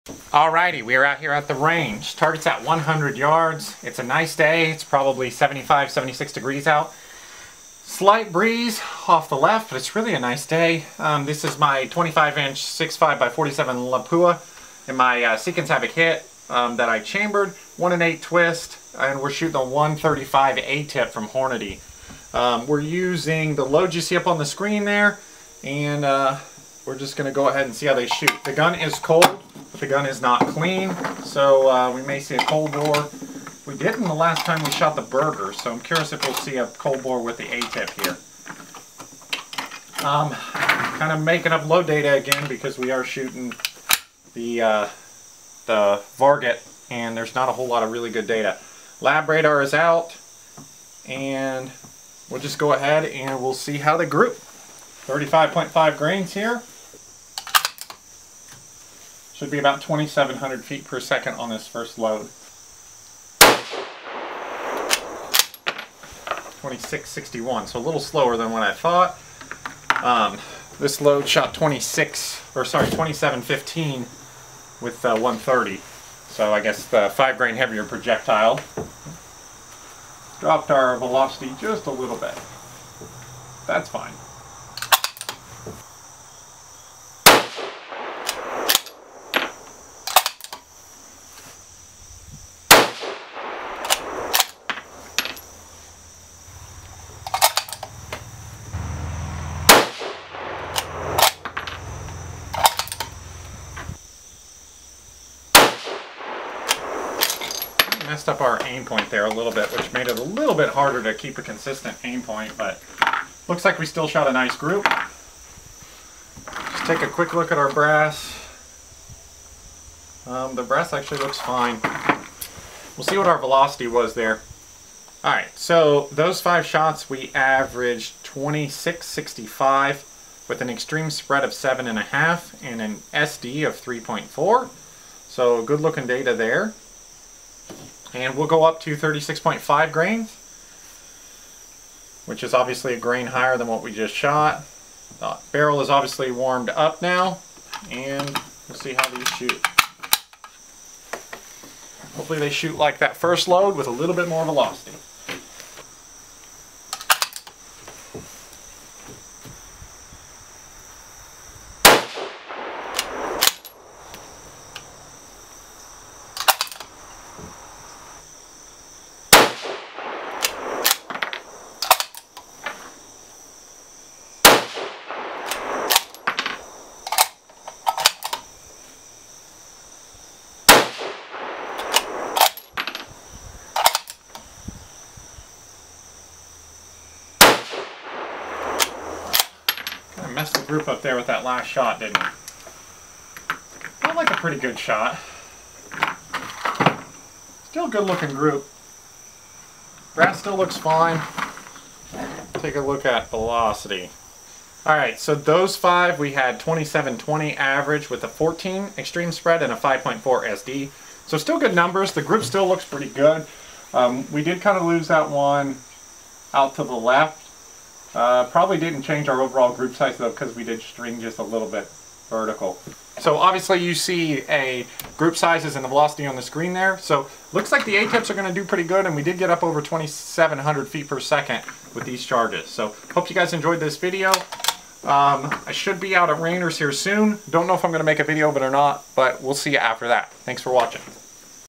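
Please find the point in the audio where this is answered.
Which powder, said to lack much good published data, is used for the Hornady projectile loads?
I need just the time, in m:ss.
0:46.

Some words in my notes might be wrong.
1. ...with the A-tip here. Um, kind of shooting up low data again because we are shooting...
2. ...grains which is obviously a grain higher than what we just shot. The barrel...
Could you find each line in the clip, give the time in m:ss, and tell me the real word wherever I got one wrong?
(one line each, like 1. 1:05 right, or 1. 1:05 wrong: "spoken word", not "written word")
1. 0:37 wrong: "making", not "shooting"
2. 2:19 right.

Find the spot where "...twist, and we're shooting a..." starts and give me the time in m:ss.
0:18.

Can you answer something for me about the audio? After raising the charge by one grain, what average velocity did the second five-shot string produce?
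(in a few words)
2720.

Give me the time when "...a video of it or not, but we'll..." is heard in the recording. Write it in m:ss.
3:58.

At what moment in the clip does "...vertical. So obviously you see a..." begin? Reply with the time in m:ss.
3:42.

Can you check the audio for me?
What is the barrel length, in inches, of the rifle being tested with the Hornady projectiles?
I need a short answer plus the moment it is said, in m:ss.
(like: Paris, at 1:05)
25, at 0:11.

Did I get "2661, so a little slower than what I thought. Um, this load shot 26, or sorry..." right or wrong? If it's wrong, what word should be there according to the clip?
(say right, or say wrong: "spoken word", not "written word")
right.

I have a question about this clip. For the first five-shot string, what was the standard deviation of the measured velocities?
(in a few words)
3.4.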